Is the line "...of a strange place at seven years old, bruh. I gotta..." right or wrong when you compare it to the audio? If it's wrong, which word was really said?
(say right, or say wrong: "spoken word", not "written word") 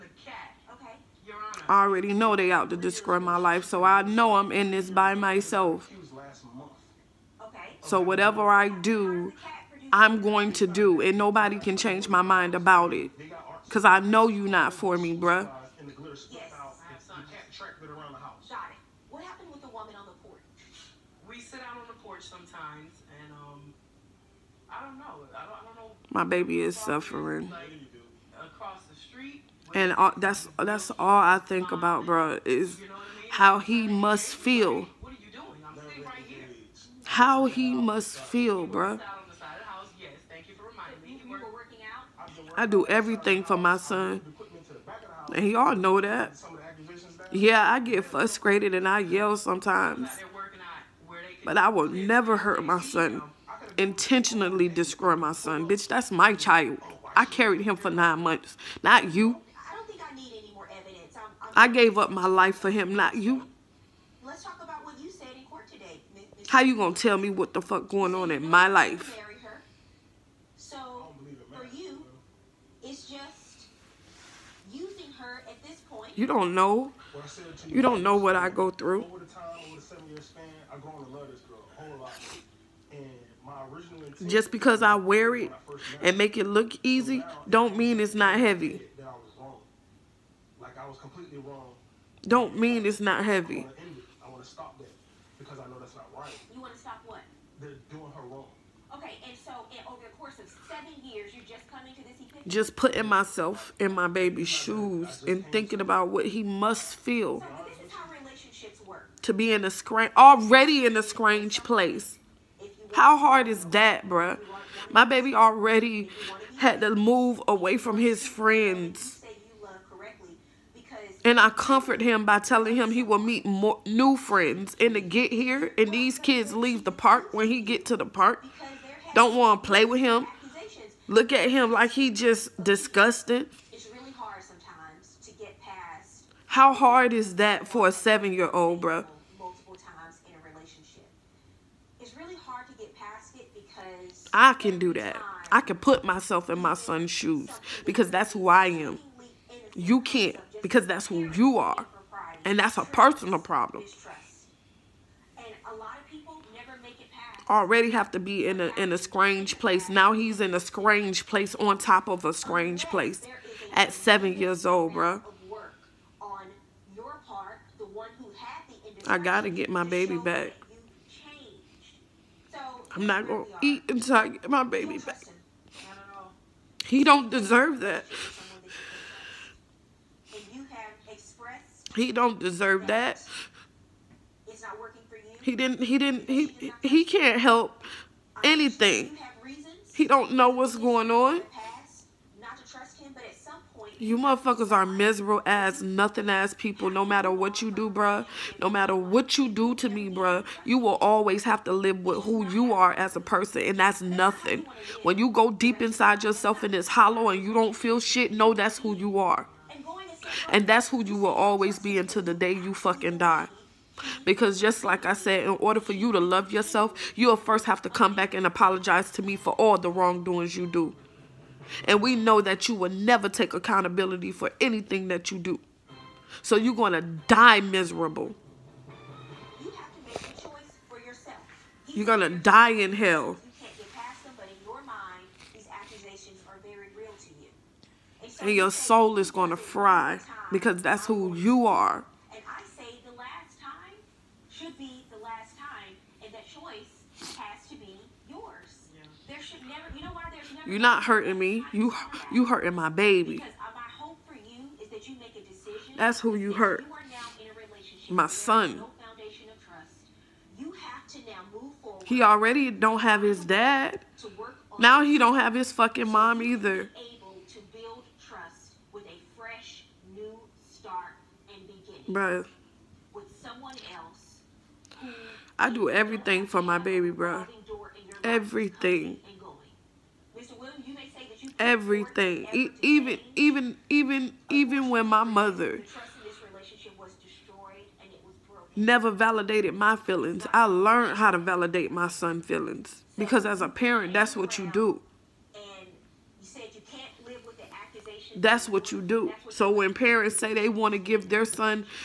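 right.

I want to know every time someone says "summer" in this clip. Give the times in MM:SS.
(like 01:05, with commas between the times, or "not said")
not said.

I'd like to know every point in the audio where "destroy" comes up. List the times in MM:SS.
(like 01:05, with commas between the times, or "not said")
00:02, 00:54.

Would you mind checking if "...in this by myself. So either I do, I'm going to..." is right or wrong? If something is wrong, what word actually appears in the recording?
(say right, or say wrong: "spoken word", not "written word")
wrong: "whatever", not "either".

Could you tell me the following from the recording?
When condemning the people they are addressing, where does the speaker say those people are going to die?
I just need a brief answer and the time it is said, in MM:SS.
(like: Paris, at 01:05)
in hell, at 03:52.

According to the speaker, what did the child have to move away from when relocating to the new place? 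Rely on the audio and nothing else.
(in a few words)
his friends.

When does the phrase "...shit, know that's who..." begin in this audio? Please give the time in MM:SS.
03:27.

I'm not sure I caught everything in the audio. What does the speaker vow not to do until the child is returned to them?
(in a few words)
eat.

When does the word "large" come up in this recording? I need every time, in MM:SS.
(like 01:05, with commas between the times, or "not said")
not said.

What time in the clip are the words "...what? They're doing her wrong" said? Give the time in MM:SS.
01:37.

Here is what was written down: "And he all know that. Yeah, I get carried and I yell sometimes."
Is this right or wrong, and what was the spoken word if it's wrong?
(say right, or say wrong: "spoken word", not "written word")
wrong: "frustrated", not "carried".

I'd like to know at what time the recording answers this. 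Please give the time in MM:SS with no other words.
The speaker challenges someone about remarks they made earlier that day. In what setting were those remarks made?
01:05.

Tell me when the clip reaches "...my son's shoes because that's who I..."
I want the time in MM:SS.
02:26.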